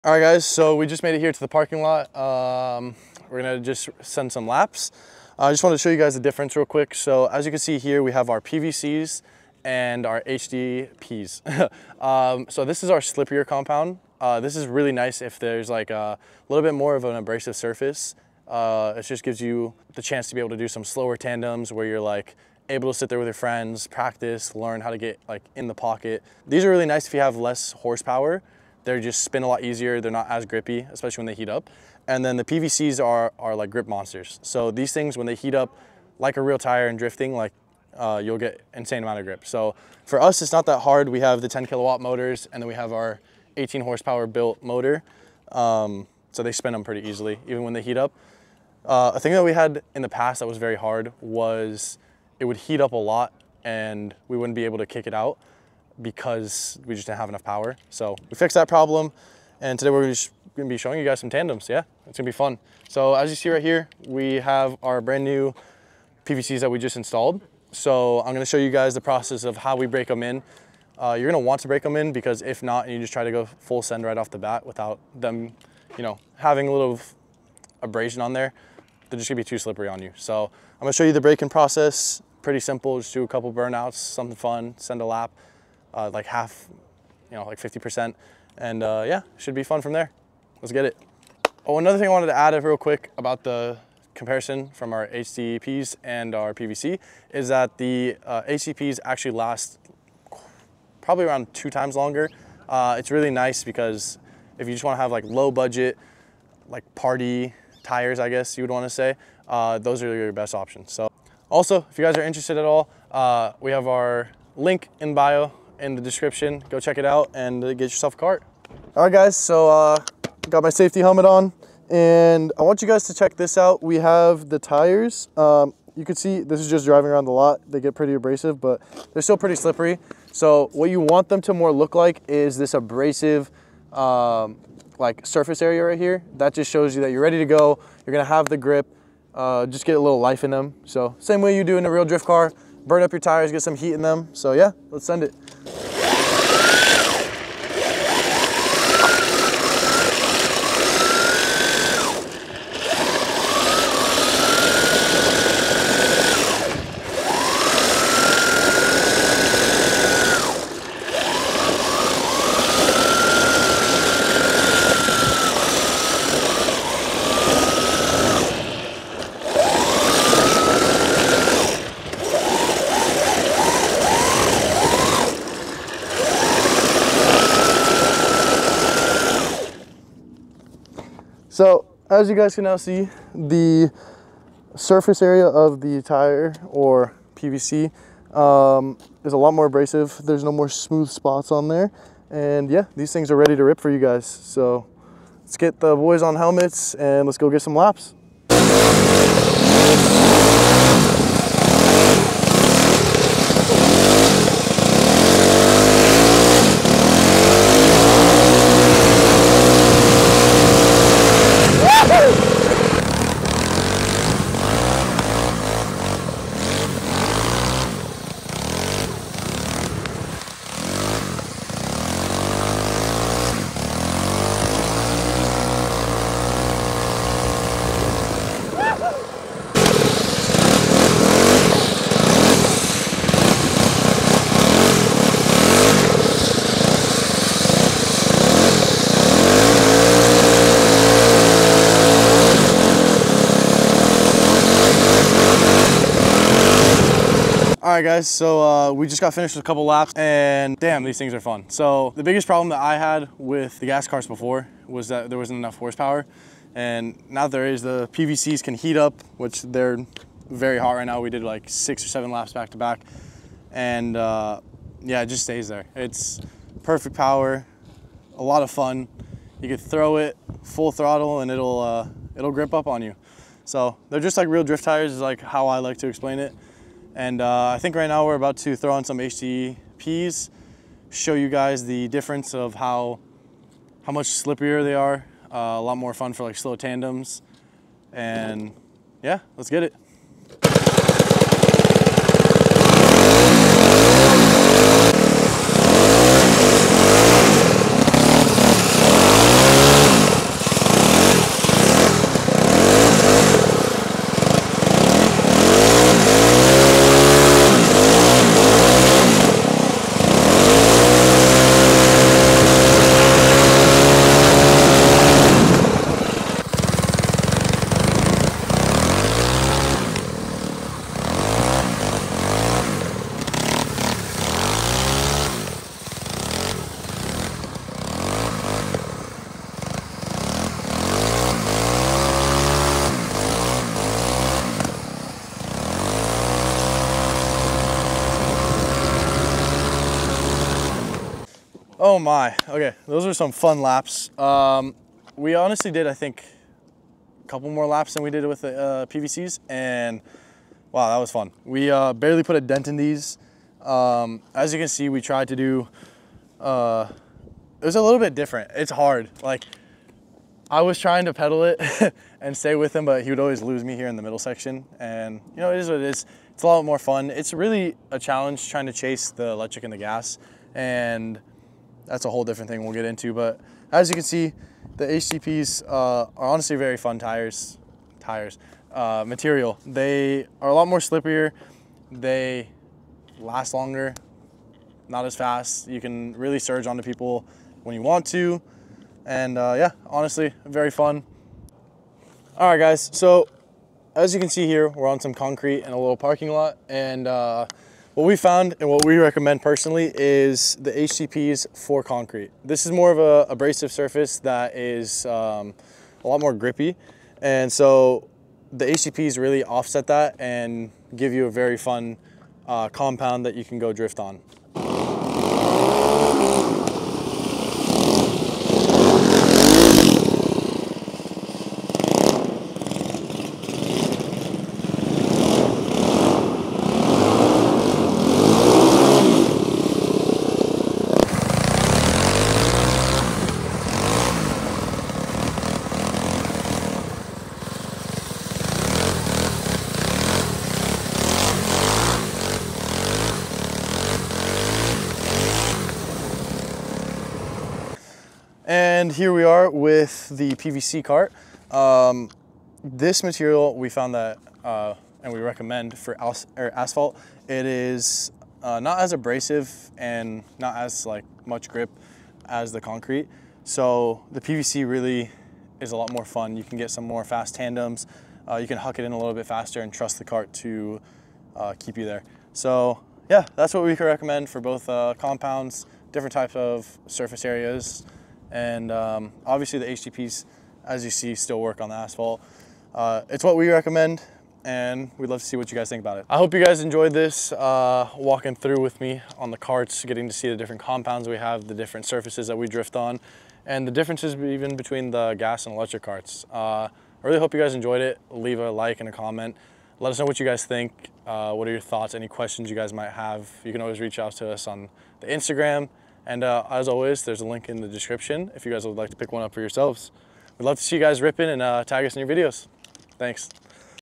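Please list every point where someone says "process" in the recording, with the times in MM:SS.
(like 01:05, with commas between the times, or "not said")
01:09, 01:21.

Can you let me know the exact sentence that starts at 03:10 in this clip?
There's no more smooth spots on there.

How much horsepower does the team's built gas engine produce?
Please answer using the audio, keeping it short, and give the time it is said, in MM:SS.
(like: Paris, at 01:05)
18 horsepower, at 00:43.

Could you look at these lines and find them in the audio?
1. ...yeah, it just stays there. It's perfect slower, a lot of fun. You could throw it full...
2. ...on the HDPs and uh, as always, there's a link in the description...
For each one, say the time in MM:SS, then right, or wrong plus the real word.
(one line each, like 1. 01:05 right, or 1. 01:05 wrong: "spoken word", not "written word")
1. 04:25 wrong: "power", not "slower"
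2. 08:24 wrong: "Instagram", not "HDPs".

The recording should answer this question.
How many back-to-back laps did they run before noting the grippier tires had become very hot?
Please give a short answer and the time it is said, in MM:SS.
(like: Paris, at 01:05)
Six or seven, at 04:21.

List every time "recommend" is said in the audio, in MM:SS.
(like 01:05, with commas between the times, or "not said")
06:39, 07:35, 07:54, 08:03.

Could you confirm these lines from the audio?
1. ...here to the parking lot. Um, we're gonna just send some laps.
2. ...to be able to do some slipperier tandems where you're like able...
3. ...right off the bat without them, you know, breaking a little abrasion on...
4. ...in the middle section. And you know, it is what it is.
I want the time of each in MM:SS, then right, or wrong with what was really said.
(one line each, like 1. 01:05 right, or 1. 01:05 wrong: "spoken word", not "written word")
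1. 00:01 right
2. 00:20 wrong: "slower", not "slipperier"
3. 01:14 wrong: "having", not "breaking"
4. 06:04 right.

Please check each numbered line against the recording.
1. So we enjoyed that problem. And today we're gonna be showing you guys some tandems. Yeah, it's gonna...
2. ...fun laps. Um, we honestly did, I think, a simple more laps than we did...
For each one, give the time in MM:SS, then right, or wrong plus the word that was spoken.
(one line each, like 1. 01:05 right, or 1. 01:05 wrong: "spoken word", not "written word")
1. 00:57 wrong: "fixed", not "enjoyed"
2. 05:43 wrong: "couple", not "simple".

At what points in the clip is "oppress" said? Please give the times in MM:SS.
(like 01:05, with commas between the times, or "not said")
not said.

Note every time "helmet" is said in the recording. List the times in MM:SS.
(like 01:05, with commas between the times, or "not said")
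02:01, 03:16.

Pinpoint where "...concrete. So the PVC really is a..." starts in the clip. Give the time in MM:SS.
07:42.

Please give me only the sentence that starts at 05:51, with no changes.
We uh, barely put a dent in these.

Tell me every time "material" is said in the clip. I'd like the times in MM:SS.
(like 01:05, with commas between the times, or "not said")
06:19, 07:33.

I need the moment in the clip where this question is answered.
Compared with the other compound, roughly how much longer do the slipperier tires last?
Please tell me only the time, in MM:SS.
01:41.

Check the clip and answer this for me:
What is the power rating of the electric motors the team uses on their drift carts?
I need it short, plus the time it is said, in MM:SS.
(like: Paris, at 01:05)
10 kilowatt, at 00:41.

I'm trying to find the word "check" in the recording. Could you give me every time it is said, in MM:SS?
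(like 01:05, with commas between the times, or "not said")
01:56, 02:03.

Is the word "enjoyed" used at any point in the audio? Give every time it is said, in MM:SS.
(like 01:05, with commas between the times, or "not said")
08:06, 08:17.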